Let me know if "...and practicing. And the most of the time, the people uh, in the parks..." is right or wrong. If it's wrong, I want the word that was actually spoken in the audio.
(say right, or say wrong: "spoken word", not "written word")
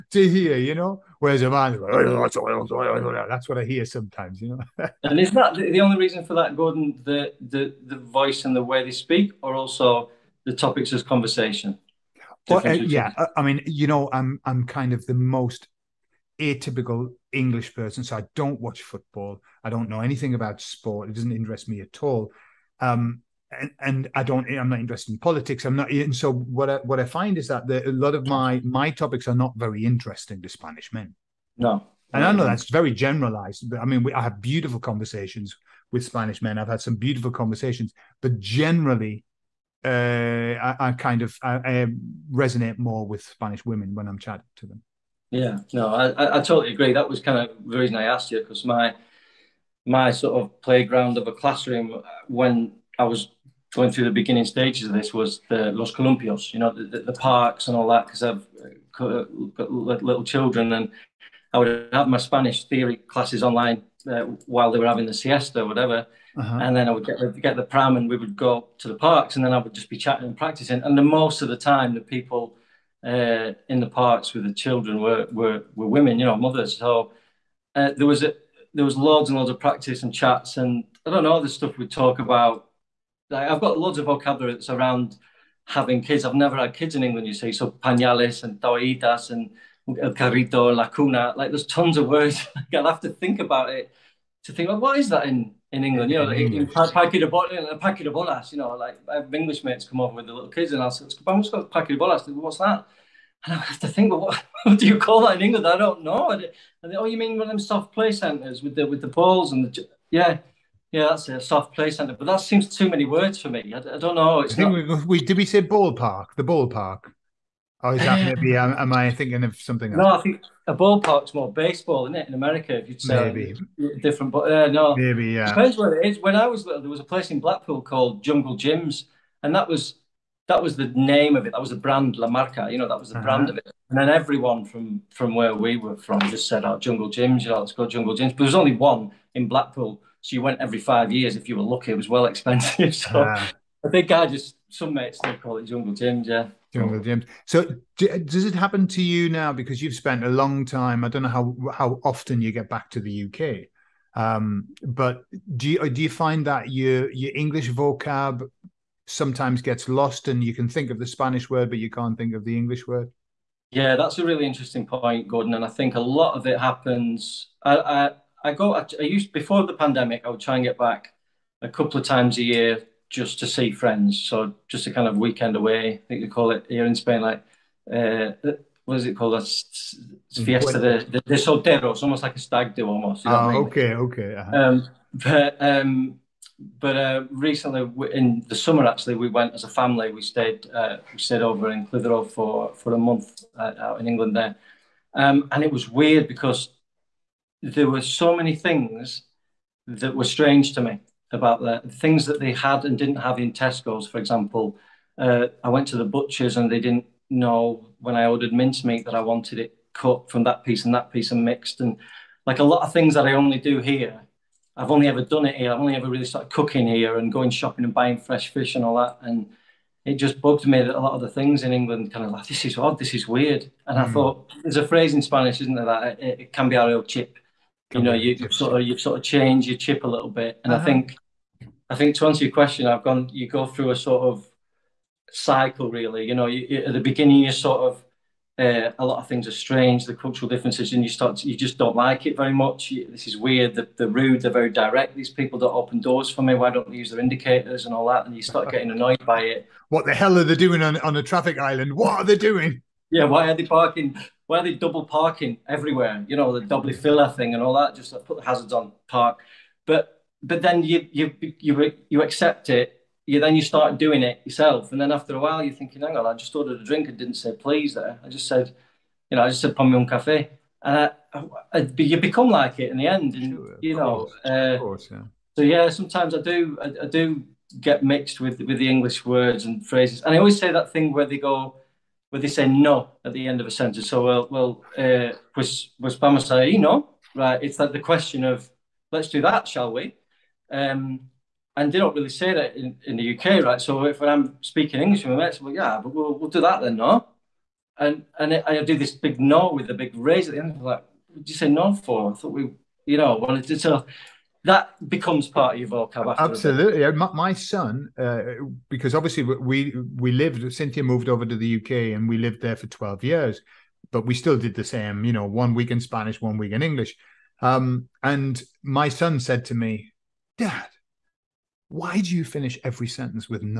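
right.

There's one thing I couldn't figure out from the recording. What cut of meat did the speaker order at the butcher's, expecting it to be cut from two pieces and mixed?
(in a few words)
Mincemeat.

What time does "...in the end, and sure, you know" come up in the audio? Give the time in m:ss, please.
4:32.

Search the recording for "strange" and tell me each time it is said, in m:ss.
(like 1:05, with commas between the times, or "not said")
3:20, 3:59.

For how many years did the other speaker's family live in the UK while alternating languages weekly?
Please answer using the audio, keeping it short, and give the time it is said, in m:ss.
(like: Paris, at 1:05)
12, at 5:12.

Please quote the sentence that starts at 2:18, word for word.
But there was only one in Blackpool so you went every five years if you were lucky.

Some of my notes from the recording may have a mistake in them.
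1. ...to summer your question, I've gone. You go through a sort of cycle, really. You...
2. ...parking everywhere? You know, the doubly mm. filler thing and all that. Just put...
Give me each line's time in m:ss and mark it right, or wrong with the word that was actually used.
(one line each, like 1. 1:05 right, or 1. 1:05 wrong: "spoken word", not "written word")
1. 3:52 wrong: "answer", not "summer"
2. 4:15 right.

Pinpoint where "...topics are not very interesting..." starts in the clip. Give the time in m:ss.
0:28.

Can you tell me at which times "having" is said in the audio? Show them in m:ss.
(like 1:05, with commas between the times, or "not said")
1:04, 1:25.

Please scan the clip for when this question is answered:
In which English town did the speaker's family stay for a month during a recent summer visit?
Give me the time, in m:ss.
3:11.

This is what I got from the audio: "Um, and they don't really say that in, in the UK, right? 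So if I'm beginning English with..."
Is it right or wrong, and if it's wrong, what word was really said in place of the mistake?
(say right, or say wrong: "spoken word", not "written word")
wrong: "speaking", not "beginning".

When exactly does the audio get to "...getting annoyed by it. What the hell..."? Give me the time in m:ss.
4:08.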